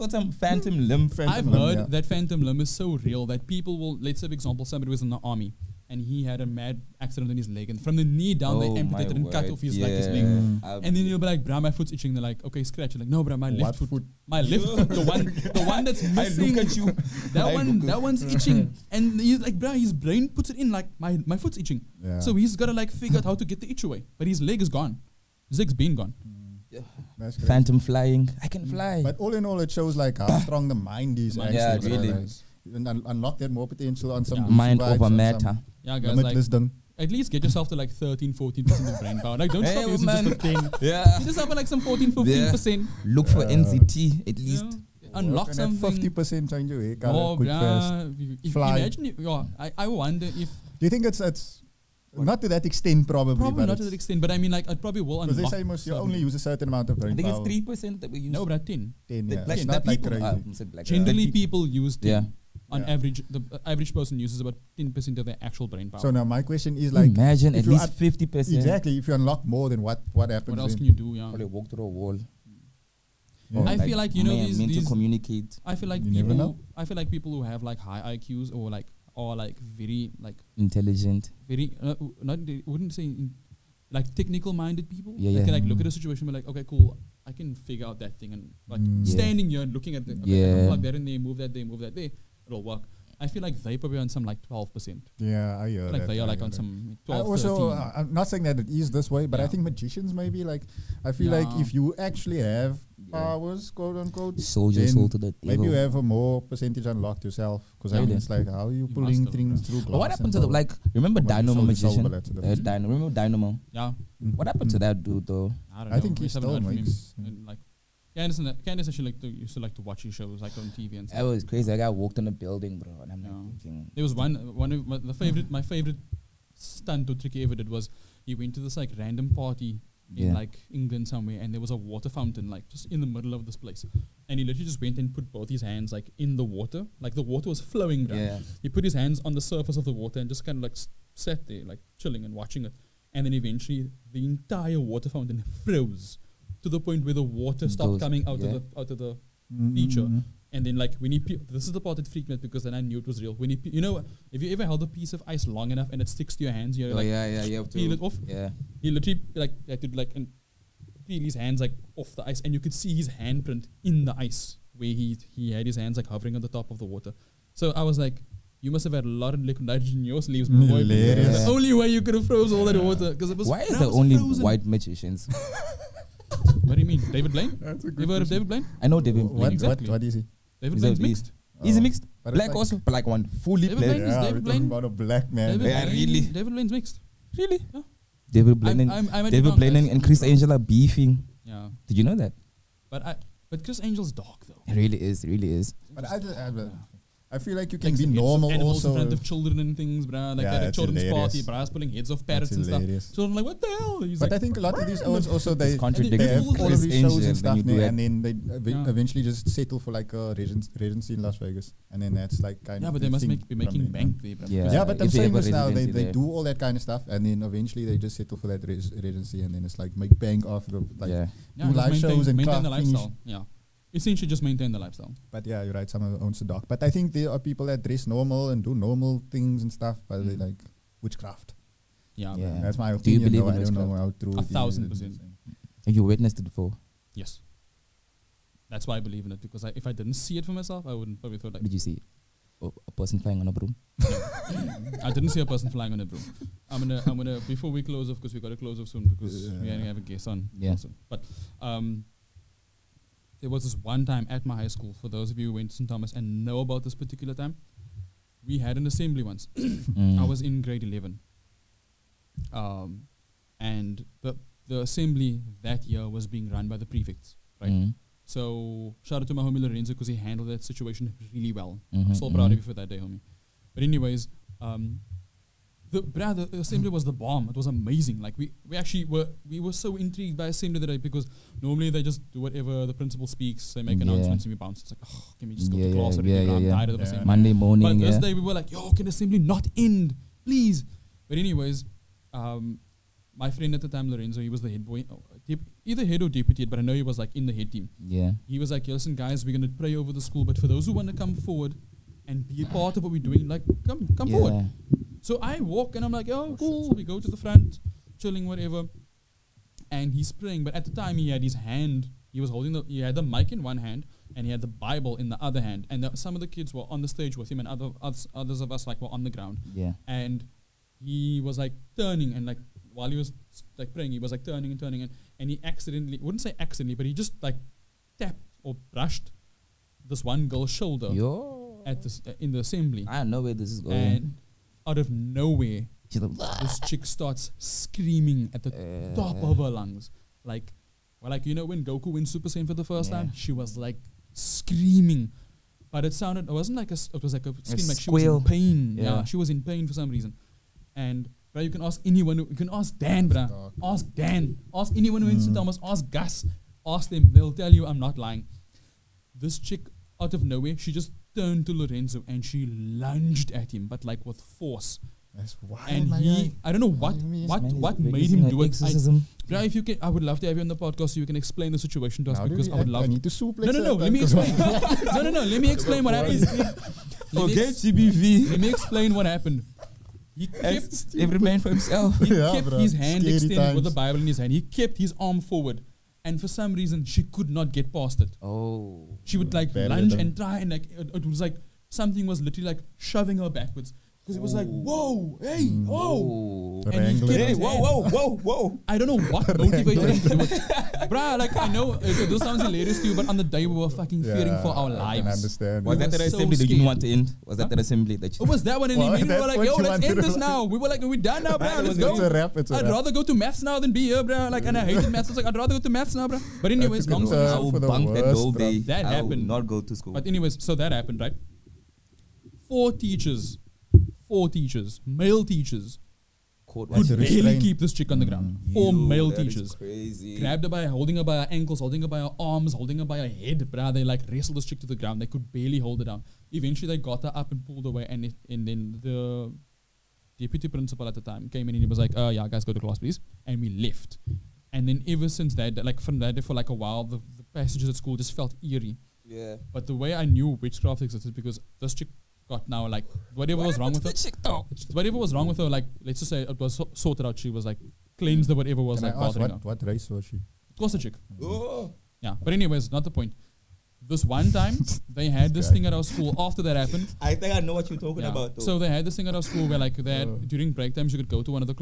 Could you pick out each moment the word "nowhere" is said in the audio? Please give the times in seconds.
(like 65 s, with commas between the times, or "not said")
335 s, 360 s.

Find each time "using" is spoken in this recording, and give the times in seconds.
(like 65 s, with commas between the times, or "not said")
39 s.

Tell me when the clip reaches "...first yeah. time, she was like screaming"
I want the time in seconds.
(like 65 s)
342 s.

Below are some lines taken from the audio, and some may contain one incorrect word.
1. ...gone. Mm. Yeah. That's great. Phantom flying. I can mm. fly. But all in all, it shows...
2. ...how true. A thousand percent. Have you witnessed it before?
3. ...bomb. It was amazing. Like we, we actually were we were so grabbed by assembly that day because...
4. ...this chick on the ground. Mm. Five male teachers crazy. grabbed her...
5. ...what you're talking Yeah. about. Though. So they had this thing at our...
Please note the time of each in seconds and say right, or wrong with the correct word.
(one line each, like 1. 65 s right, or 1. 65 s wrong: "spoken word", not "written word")
1. 25 s right
2. 233 s right
3. 277 s wrong: "intrigued", not "grabbed"
4. 427 s wrong: "Four", not "Five"
5. 467 s right.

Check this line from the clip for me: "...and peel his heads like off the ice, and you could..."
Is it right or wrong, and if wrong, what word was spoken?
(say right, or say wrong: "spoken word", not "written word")
wrong: "hands", not "heads".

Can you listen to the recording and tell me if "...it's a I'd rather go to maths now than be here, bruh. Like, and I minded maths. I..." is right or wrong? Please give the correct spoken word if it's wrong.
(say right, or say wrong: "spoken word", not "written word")
wrong: "hated", not "minded".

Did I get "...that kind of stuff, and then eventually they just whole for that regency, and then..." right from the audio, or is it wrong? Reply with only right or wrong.
wrong.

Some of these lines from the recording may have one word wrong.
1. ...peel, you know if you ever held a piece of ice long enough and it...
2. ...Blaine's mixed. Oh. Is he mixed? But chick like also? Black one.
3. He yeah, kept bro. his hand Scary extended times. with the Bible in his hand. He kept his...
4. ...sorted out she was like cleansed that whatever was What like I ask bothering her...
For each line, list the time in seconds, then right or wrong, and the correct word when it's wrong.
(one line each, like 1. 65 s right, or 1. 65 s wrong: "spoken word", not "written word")
1. 153 s right
2. 180 s wrong: "black", not "chick"
3. 382 s right
4. 456 s wrong: "Can", not "What".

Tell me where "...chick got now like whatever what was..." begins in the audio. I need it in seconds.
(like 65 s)
451 s.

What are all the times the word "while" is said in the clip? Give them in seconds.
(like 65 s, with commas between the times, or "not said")
322 s, 446 s.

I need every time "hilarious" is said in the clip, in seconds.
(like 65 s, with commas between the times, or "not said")
201 s, 402 s.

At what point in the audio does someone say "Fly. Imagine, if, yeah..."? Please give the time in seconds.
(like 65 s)
48 s.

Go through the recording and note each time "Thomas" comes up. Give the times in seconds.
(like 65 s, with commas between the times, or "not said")
255 s, 355 s.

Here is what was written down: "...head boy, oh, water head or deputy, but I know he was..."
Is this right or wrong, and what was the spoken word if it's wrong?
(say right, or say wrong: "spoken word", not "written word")
wrong: "either", not "water".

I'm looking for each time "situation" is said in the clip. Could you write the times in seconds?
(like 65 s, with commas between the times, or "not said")
85 s, 270 s, 371 s.